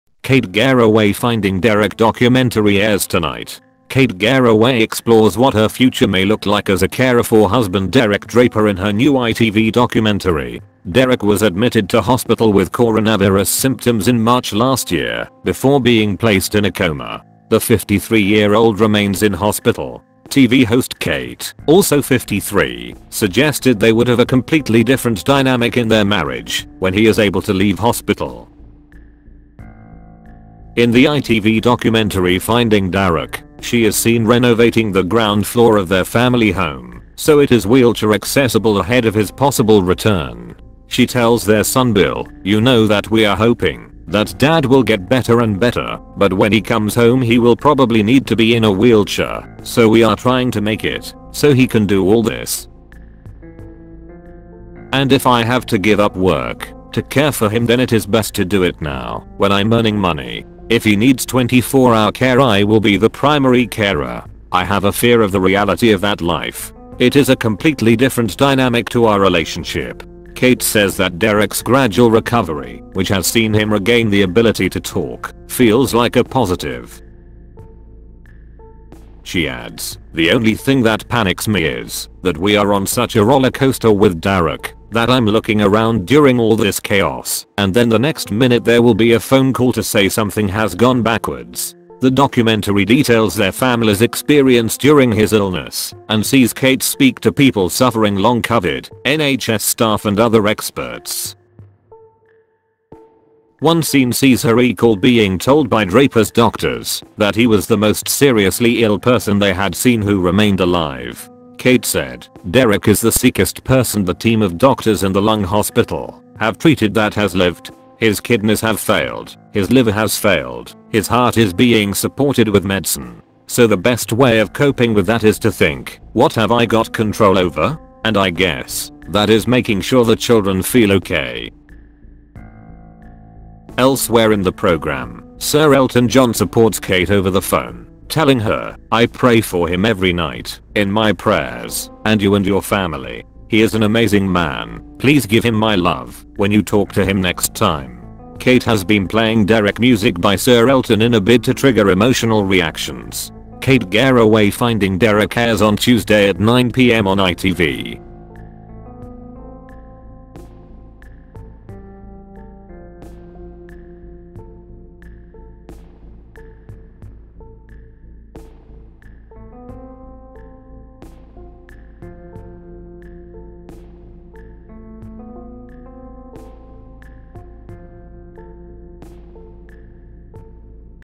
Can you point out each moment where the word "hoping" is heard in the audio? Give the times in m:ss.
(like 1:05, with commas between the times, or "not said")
0:43.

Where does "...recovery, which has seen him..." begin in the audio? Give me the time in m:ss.
1:12.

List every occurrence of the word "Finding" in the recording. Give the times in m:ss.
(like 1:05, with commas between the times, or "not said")
0:01, 0:32, 2:34.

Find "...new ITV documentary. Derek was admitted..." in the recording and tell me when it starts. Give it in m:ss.
0:08.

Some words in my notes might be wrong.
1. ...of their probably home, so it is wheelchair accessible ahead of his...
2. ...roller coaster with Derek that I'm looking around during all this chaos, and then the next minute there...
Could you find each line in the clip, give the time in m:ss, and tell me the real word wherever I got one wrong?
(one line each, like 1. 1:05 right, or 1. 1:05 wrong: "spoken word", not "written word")
1. 0:35 wrong: "family", not "probably"
2. 1:23 right.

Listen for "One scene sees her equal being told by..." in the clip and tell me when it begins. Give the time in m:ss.
1:43.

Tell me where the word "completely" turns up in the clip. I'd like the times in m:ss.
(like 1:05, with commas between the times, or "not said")
0:24, 1:07.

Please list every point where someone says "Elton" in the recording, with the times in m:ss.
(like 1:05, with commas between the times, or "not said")
2:15, 2:30.